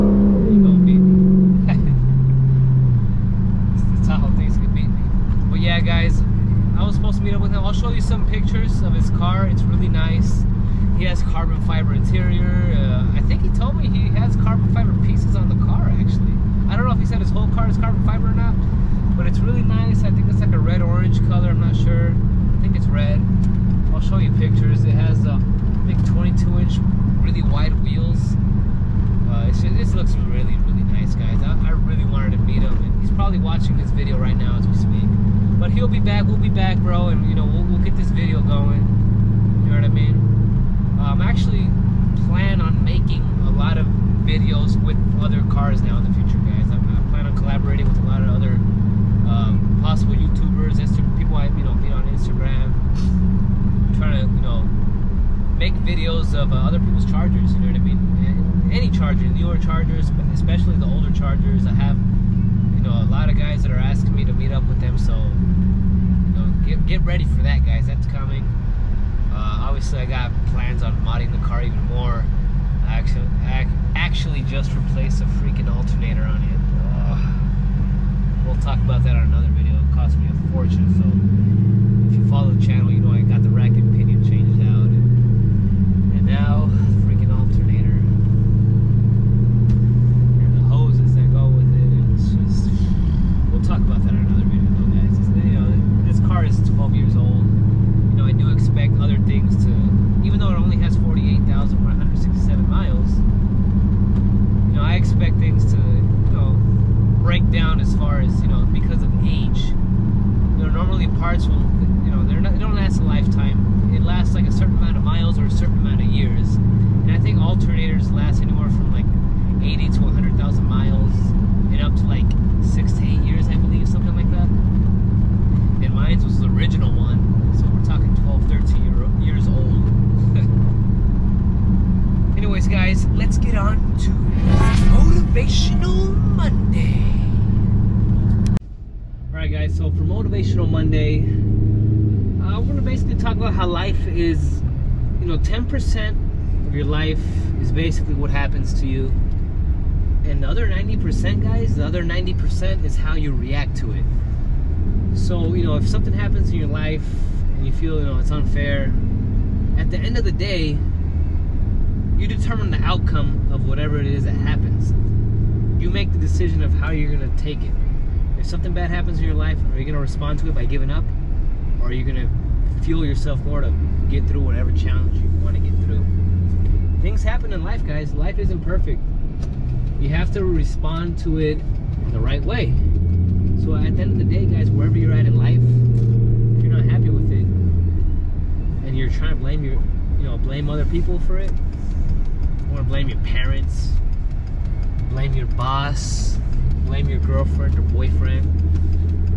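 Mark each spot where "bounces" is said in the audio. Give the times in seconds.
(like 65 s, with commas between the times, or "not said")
not said.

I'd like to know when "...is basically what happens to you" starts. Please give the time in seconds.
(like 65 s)
147 s.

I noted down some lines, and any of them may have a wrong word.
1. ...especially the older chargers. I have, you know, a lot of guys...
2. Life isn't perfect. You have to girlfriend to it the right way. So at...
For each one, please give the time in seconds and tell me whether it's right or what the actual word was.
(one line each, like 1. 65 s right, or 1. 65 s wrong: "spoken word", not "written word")
1. 60 s right
2. 178 s wrong: "respond", not "girlfriend".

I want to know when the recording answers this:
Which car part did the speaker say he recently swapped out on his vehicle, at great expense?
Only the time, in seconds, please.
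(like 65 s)
75 s.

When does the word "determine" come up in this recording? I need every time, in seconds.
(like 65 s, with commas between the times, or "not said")
162 s.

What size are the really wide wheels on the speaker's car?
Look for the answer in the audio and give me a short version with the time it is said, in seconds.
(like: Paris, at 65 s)
22 inch, at 26 s.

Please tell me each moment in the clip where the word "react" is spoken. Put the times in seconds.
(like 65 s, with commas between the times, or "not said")
153 s.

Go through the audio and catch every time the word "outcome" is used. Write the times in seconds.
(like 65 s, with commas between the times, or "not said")
162 s.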